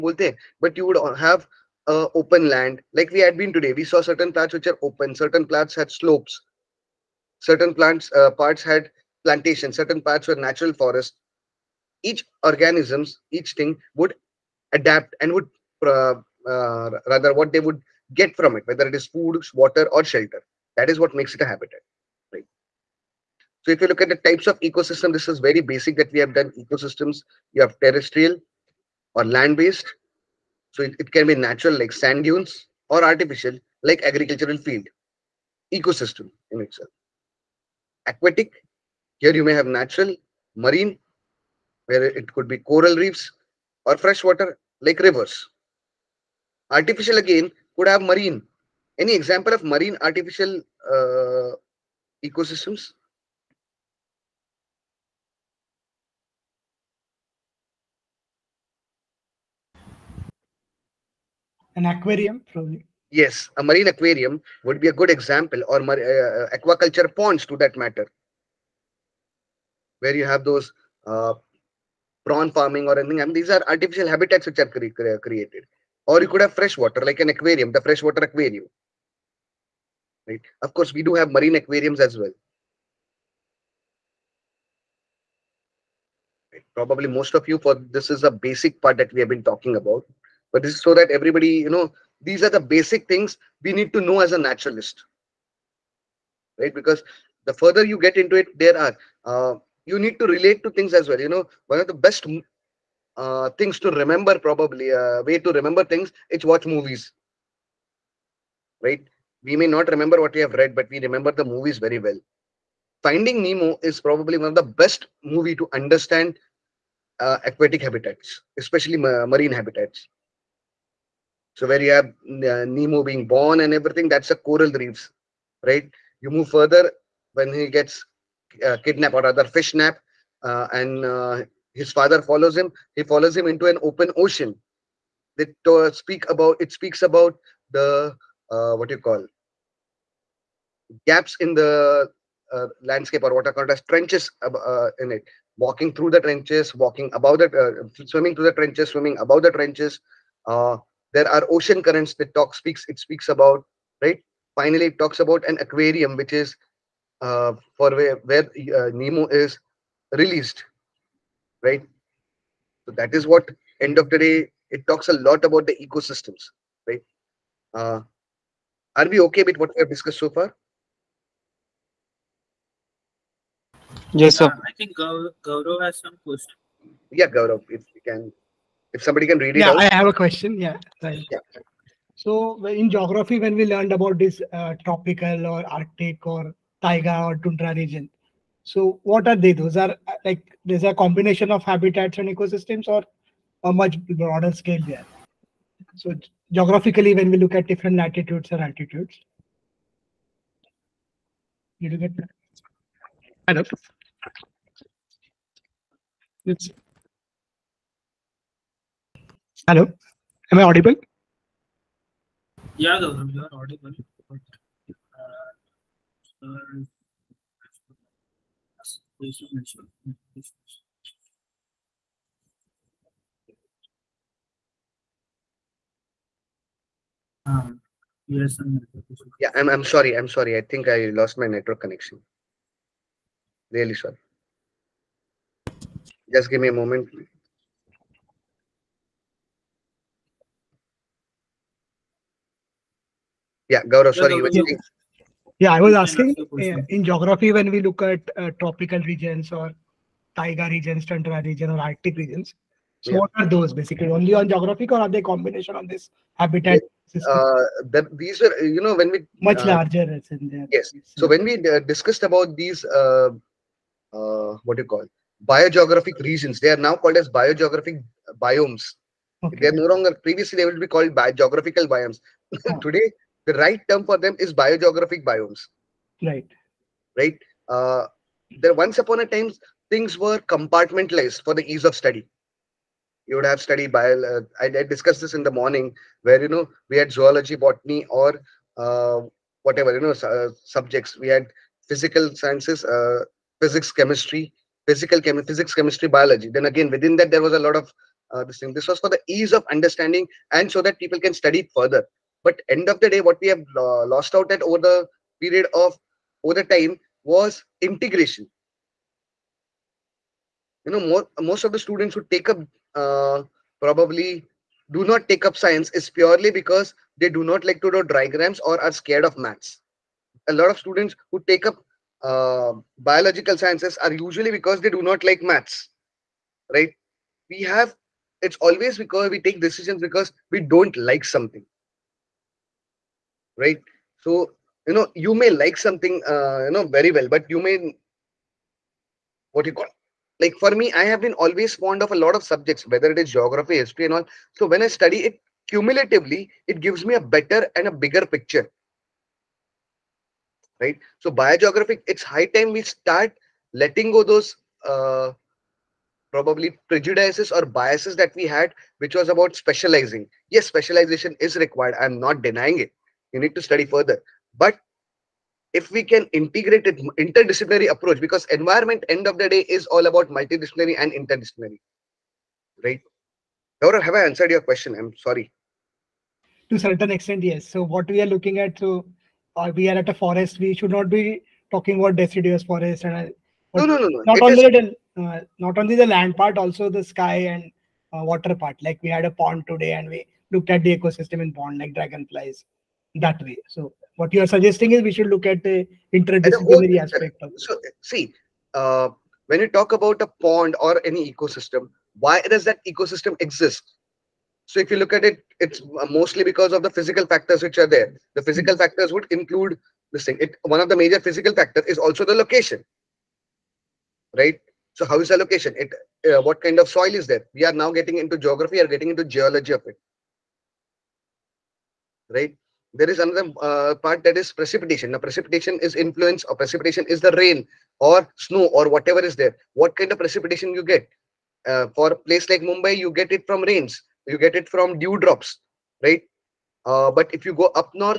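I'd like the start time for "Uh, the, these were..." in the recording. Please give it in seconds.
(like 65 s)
257 s.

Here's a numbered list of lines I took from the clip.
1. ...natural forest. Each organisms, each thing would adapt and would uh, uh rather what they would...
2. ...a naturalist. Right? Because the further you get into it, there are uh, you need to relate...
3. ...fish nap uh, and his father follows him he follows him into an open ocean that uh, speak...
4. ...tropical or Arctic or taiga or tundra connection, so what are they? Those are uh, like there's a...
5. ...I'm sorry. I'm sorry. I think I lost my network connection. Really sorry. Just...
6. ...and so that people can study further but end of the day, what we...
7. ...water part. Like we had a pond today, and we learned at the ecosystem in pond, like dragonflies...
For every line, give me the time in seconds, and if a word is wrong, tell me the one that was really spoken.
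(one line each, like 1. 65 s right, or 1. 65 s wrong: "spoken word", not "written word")
1. 10 s right
2. 94 s right
3. 129 s right
4. 184 s wrong: "region", not "connection"
5. 229 s right
6. 300 s right
7. 388 s wrong: "looked", not "learned".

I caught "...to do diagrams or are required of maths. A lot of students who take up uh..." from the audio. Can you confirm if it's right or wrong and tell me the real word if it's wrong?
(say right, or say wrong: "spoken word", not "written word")
wrong: "scared", not "required".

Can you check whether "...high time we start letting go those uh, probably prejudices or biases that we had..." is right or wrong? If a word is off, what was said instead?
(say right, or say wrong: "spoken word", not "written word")
right.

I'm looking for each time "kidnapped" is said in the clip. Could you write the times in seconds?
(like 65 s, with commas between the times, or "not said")
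128 s.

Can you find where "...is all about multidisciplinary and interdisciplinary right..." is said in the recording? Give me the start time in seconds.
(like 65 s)
369 s.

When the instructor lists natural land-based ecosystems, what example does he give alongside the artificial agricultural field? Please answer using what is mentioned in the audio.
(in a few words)
Sand dunes.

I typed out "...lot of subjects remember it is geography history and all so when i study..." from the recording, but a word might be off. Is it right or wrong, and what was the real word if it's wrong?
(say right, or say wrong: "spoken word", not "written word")
wrong: "whether", not "remember".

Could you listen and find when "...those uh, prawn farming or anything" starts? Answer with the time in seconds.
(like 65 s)
70 s.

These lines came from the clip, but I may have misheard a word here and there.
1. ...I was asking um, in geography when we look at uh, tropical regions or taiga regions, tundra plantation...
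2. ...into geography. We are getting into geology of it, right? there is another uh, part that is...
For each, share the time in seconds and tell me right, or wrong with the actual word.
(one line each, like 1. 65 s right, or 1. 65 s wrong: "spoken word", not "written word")
1. 245 s wrong: "region", not "plantation"
2. 418 s right.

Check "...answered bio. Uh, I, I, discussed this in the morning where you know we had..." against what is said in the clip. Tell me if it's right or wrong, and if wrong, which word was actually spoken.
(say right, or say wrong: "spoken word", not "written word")
wrong: "studied", not "answered".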